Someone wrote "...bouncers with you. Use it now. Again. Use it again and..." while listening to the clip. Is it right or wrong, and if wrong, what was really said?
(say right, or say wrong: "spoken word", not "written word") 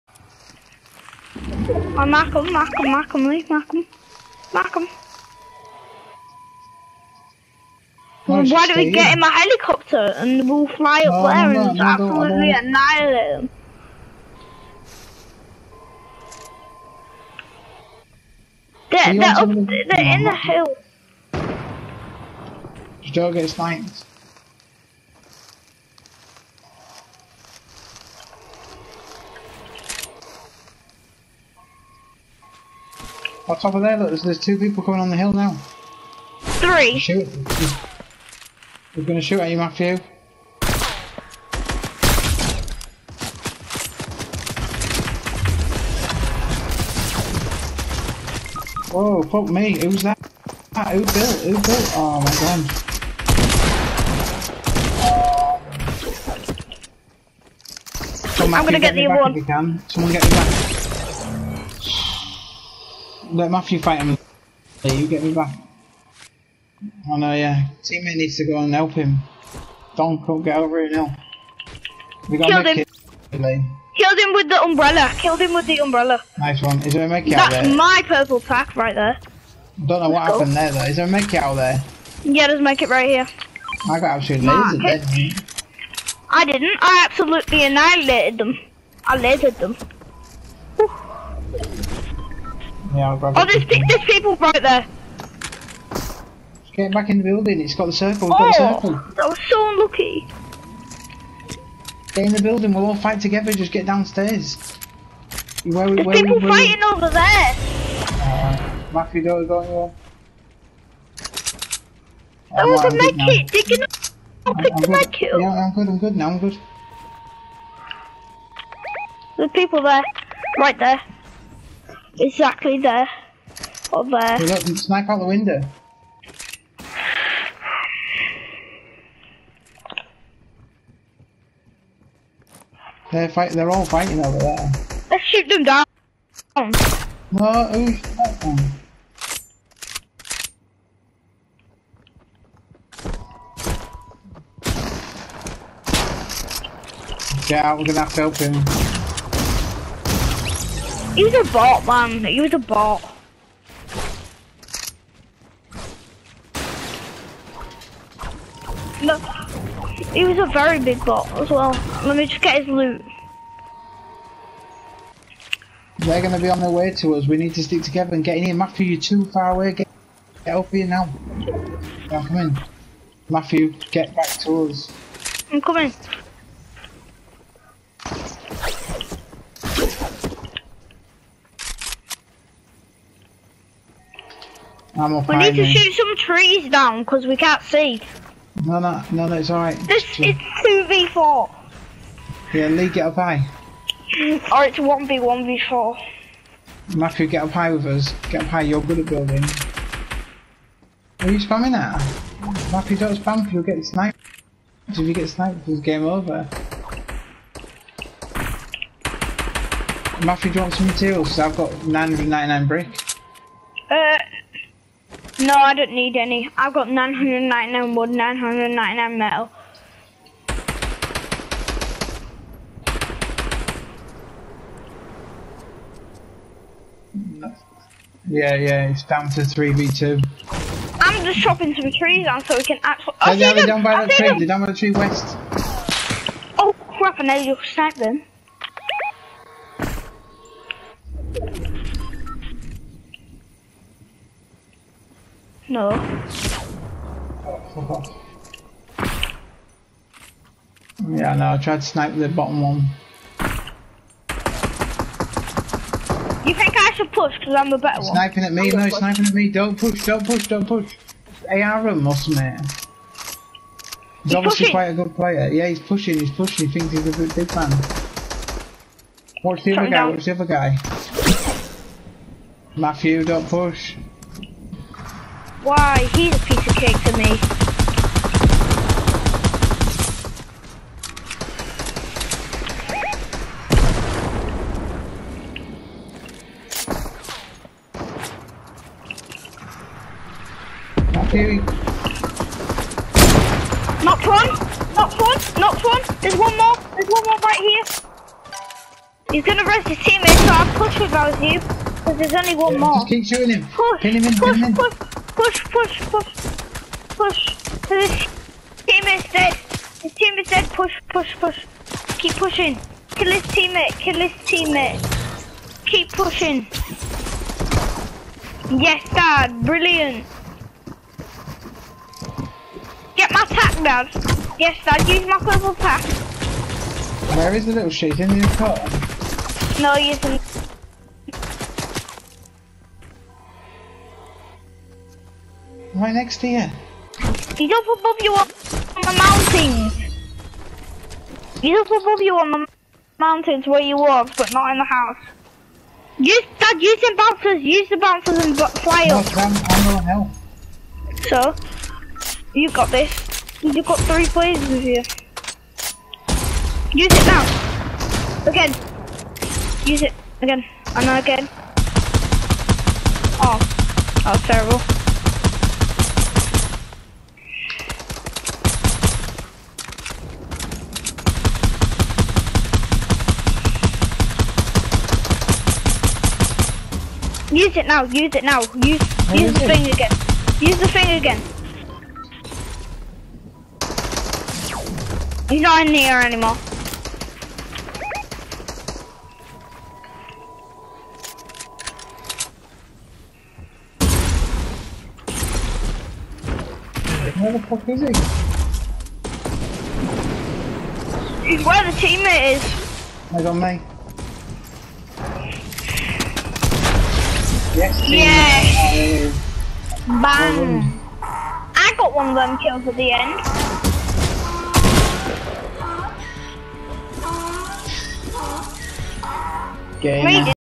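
wrong: "players", not "bouncers".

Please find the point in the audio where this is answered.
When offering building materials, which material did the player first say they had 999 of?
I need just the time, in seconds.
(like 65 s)
211 s.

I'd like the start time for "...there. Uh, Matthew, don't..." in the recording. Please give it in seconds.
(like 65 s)
107 s.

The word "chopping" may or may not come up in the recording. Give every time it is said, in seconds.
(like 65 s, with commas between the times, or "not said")
231 s.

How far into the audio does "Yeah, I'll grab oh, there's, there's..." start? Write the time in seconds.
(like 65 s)
92 s.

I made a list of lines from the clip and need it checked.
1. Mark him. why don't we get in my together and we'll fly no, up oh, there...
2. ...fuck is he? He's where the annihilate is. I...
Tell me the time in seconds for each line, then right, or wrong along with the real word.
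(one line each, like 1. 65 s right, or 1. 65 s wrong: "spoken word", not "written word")
1. 4 s wrong: "helicopter", not "together"
2. 397 s wrong: "teammate", not "annihilate".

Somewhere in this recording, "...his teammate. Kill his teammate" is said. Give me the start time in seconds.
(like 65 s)
313 s.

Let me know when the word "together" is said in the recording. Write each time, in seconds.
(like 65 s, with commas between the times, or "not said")
103 s, 167 s.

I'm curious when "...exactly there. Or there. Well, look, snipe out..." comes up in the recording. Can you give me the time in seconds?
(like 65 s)
122 s.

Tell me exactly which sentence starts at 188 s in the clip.
No, no, no, that's no, alright.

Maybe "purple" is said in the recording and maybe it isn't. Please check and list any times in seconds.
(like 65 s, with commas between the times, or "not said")
78 s, 325 s.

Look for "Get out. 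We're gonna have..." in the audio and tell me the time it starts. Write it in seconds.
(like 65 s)
147 s.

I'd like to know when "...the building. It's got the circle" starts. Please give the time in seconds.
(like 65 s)
97 s.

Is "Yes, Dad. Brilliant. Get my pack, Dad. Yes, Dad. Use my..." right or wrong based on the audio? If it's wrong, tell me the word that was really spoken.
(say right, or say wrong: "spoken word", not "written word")
right.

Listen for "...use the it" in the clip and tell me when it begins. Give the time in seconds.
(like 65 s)
378 s.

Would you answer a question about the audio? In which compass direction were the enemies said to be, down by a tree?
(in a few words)
West.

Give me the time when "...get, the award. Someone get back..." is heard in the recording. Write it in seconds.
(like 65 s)
58 s.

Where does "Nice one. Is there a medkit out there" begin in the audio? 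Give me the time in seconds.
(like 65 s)
76 s.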